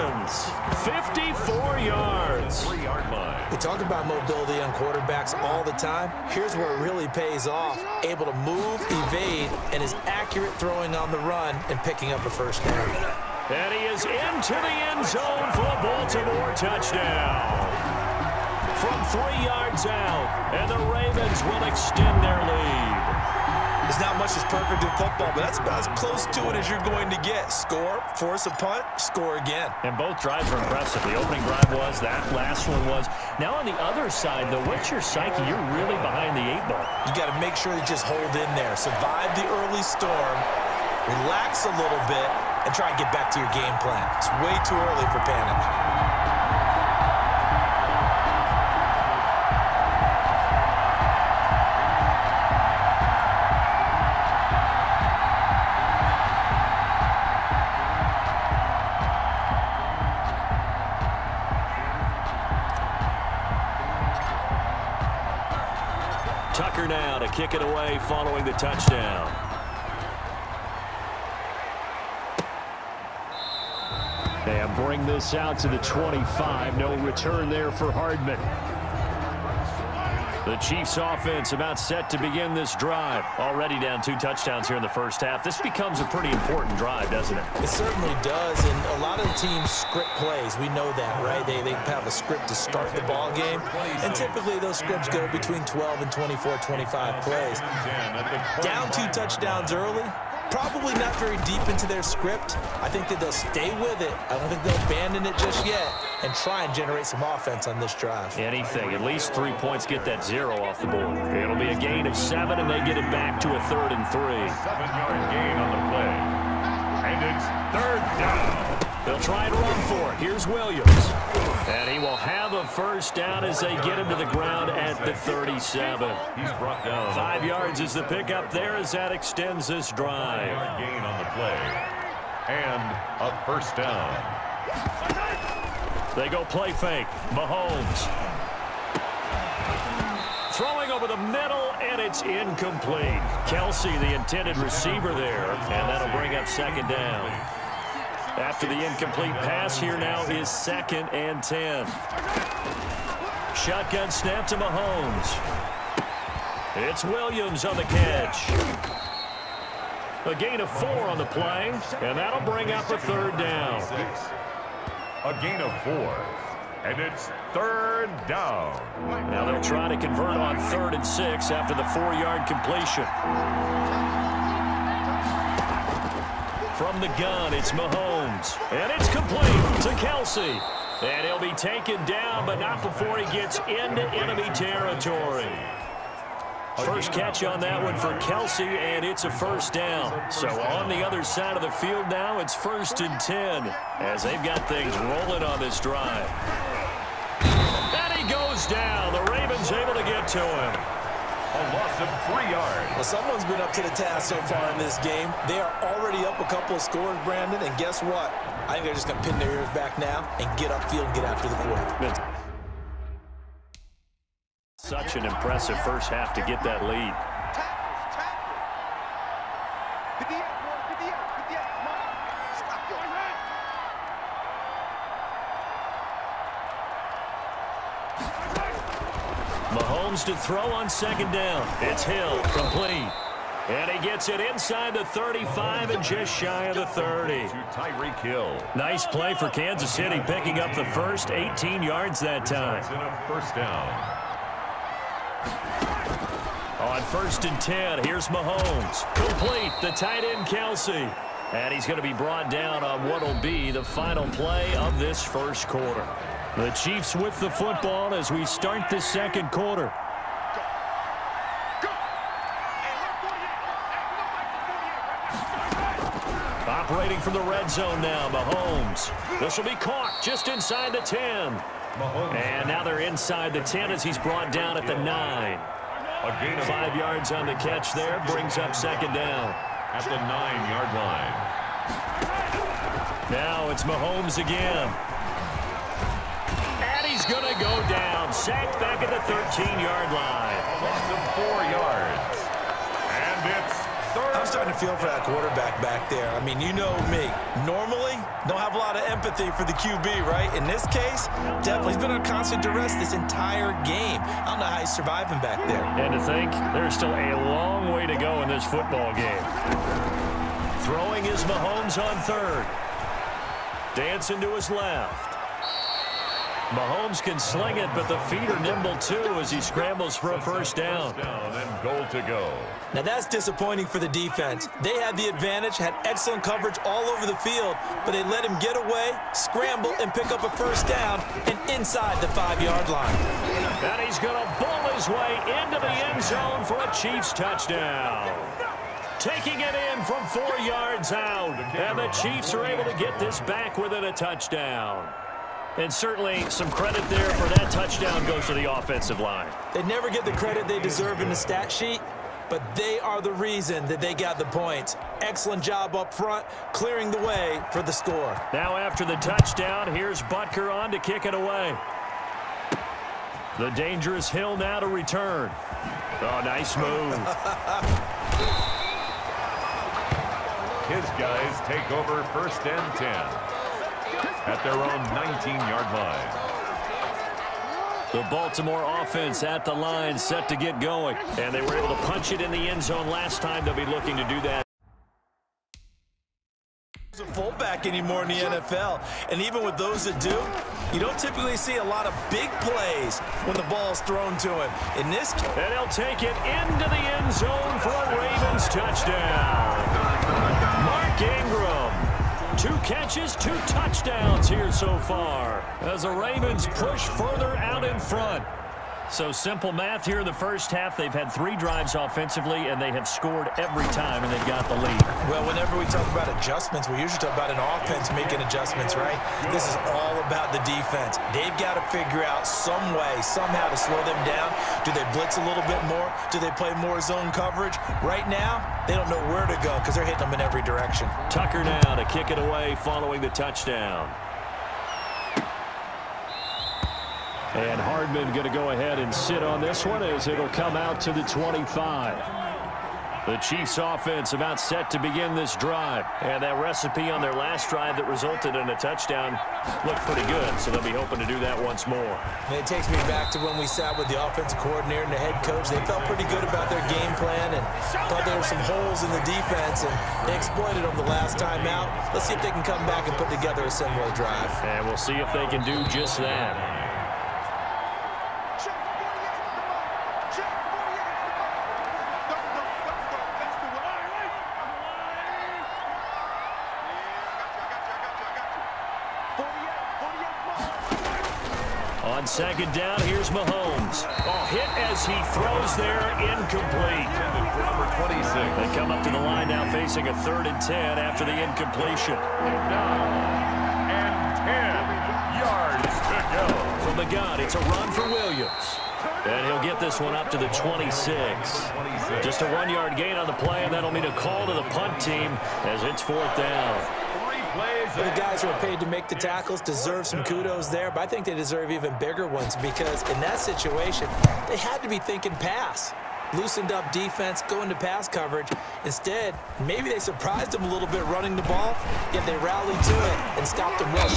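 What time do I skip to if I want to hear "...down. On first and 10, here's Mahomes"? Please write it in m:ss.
4:03.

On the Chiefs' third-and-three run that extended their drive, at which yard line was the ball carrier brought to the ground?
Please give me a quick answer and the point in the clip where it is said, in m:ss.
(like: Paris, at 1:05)
37, at 2:05.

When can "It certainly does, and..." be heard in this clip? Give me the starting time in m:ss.
1:27.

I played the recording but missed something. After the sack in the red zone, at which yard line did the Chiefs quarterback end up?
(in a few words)
13.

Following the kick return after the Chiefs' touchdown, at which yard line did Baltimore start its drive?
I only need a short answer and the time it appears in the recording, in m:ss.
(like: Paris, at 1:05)
19, at 6:15.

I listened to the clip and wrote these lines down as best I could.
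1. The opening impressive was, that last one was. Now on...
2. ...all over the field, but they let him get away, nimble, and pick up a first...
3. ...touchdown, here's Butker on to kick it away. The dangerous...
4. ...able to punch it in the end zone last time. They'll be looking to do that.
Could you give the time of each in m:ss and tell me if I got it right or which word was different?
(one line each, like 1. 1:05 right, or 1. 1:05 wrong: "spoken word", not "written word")
1. 0:31 wrong: "drive", not "impressive"
2. 5:26 wrong: "scramble", not "nimble"
3. 5:59 right
4. 6:21 right.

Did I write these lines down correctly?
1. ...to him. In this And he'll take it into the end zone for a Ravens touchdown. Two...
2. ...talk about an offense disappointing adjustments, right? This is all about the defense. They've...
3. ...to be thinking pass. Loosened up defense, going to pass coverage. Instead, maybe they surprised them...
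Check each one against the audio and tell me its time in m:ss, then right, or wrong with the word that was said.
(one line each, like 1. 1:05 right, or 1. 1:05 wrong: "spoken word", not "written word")
1. 6:34 right
2. 6:57 wrong: "making", not "disappointing"
3. 8:34 right.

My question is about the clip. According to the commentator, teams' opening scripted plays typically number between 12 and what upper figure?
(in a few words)
24.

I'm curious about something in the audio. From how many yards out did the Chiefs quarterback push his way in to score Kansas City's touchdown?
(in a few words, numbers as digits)
4.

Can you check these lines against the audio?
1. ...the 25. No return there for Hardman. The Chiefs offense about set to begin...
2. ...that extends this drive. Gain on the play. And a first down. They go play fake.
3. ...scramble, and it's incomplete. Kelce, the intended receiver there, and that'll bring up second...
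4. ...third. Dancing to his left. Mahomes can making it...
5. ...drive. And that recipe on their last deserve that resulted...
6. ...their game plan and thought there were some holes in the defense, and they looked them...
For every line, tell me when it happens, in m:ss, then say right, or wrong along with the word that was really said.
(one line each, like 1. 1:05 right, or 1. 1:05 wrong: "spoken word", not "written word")
1. 1:15 right
2. 2:08 right
3. 2:21 wrong: "middle", not "scramble"
4. 5:12 wrong: "sling", not "making"
5. 7:25 wrong: "drive", not "deserve"
6. 7:36 wrong: "exploited", not "looked".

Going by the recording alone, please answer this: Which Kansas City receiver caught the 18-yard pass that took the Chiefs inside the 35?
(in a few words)
Tyreek Hill.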